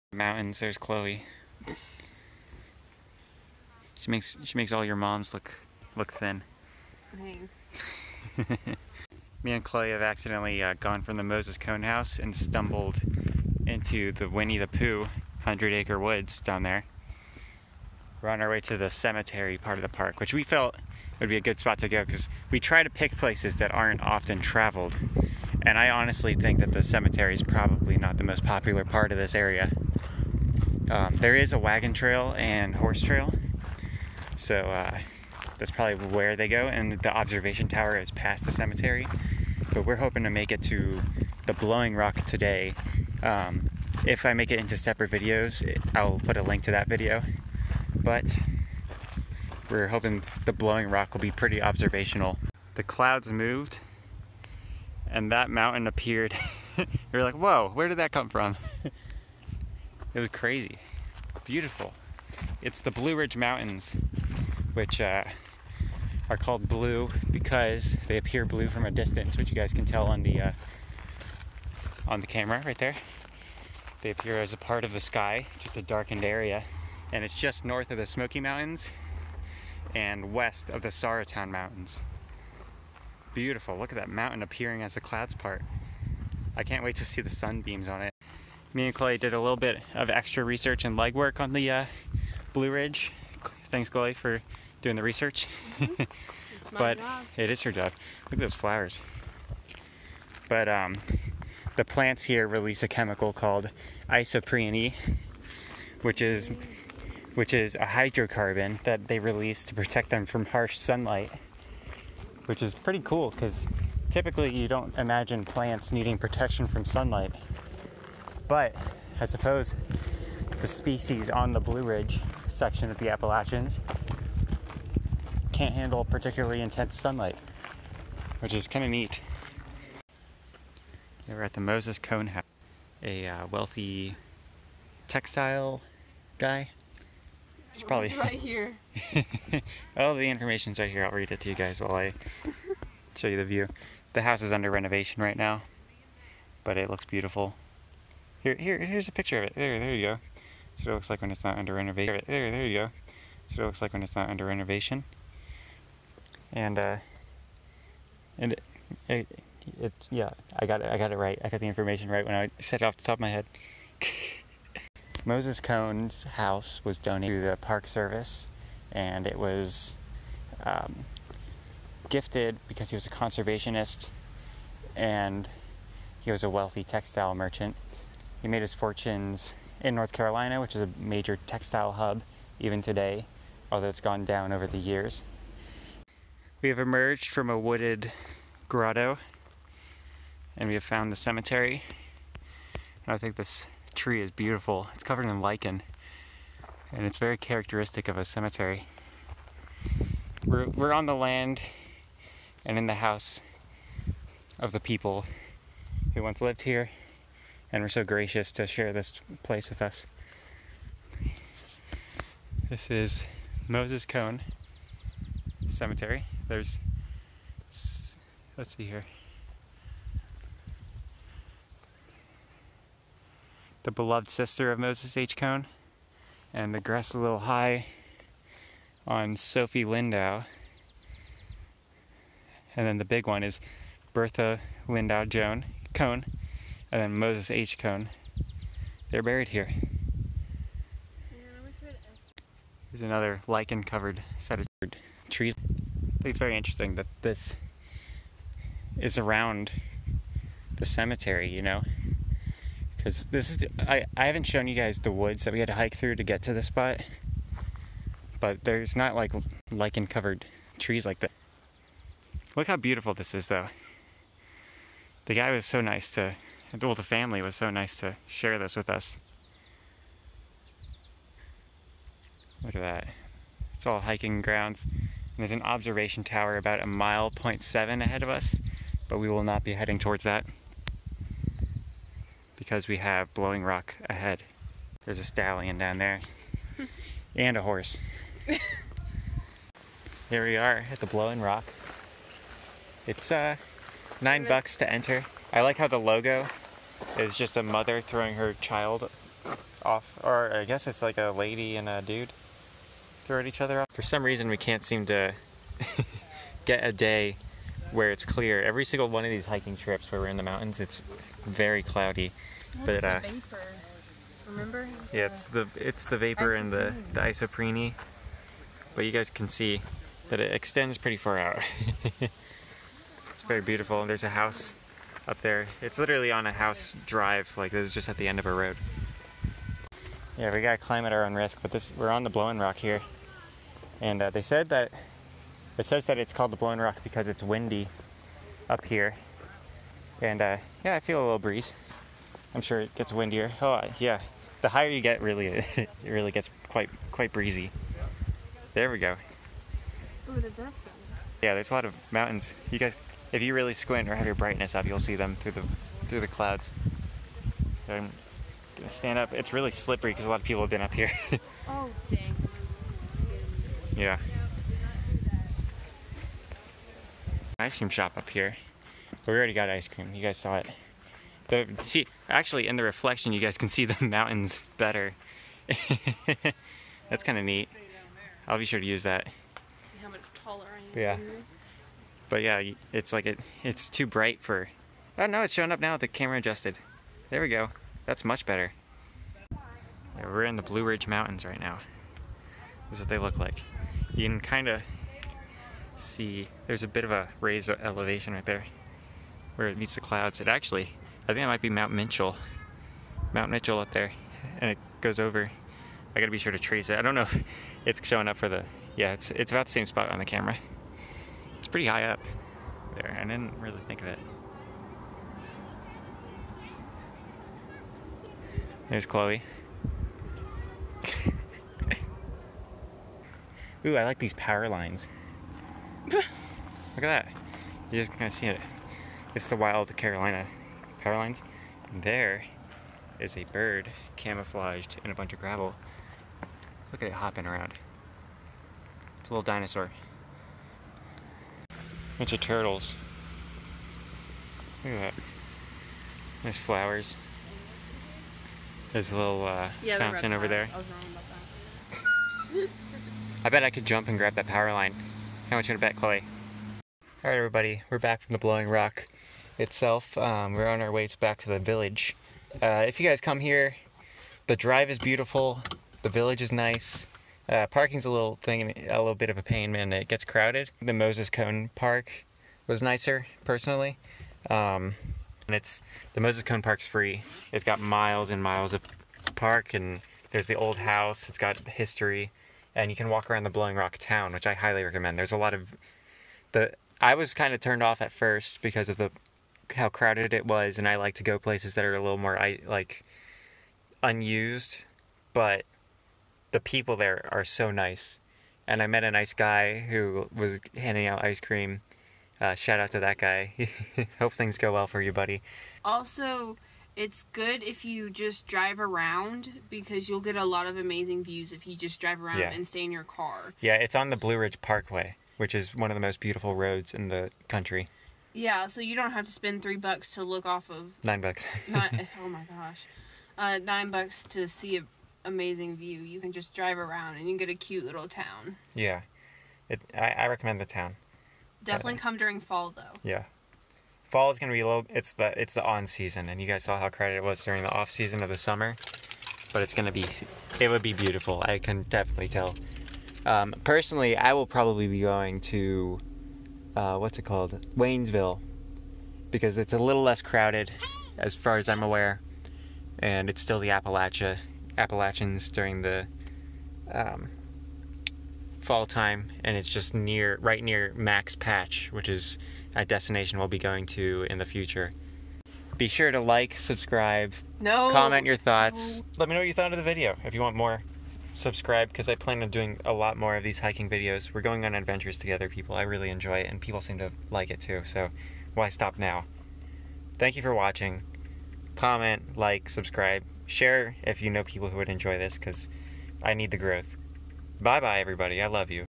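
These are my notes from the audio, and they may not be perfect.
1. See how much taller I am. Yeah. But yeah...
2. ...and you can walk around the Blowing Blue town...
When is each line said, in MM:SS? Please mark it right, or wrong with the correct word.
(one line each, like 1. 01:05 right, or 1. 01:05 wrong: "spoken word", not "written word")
1. 06:19 right
2. 08:02 wrong: "Rock", not "Blue".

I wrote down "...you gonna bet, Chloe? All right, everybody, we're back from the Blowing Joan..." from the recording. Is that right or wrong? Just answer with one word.
wrong.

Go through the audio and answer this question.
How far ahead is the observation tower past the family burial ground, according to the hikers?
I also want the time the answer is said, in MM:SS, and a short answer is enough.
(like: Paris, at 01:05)
0.7 miles, at 04:36.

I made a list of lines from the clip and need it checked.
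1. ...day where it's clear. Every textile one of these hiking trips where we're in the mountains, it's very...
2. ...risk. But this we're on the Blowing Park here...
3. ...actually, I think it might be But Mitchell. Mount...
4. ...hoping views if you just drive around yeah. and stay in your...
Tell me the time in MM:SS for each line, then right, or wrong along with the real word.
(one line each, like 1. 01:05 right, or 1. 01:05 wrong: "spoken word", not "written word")
1. 05:06 wrong: "single", not "textile"
2. 05:31 wrong: "Rock", not "Park"
3. 06:40 wrong: "Mount", not "But"
4. 08:30 wrong: "amazing", not "hoping".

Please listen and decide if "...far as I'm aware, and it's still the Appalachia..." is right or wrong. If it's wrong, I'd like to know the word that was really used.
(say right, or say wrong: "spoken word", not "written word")
right.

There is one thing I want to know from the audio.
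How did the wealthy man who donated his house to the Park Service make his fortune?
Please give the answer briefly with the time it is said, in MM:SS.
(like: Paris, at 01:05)
Textile merchant, at 02:56.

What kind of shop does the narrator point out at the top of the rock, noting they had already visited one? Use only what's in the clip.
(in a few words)
Ice cream shop.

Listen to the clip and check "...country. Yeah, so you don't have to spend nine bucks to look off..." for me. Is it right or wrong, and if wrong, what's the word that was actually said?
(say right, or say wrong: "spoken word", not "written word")
wrong: "three", not "nine".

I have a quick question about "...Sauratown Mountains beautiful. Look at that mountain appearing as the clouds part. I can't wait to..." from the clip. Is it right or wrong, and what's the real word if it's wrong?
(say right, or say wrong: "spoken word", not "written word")
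right.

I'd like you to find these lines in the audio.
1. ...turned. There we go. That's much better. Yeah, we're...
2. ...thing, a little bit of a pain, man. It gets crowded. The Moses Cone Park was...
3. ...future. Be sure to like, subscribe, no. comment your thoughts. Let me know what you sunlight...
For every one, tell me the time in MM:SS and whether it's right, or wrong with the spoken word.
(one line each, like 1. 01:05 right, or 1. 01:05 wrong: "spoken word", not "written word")
1. 06:26 wrong: "adjusted", not "turned"
2. 07:48 right
3. 09:24 wrong: "thought", not "sunlight".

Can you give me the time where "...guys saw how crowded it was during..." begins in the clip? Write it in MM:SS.
08:56.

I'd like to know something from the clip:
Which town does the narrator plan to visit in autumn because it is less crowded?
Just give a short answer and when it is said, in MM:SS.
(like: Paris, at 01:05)
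Waynesville, at 09:07.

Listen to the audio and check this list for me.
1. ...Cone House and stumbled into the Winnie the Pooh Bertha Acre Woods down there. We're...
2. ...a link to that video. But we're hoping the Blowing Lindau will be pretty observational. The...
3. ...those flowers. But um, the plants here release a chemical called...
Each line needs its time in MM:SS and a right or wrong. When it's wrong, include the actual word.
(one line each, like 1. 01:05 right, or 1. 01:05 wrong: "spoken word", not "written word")
1. 00:11 wrong: "Hundred", not "Bertha"
2. 00:46 wrong: "Rock", not "Lindau"
3. 01:38 right.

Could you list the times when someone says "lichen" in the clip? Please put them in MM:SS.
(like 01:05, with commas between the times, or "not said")
03:15, 04:03, 04:19.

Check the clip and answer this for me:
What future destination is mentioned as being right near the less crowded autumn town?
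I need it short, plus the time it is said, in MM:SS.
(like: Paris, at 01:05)
Max Patch, at 09:20.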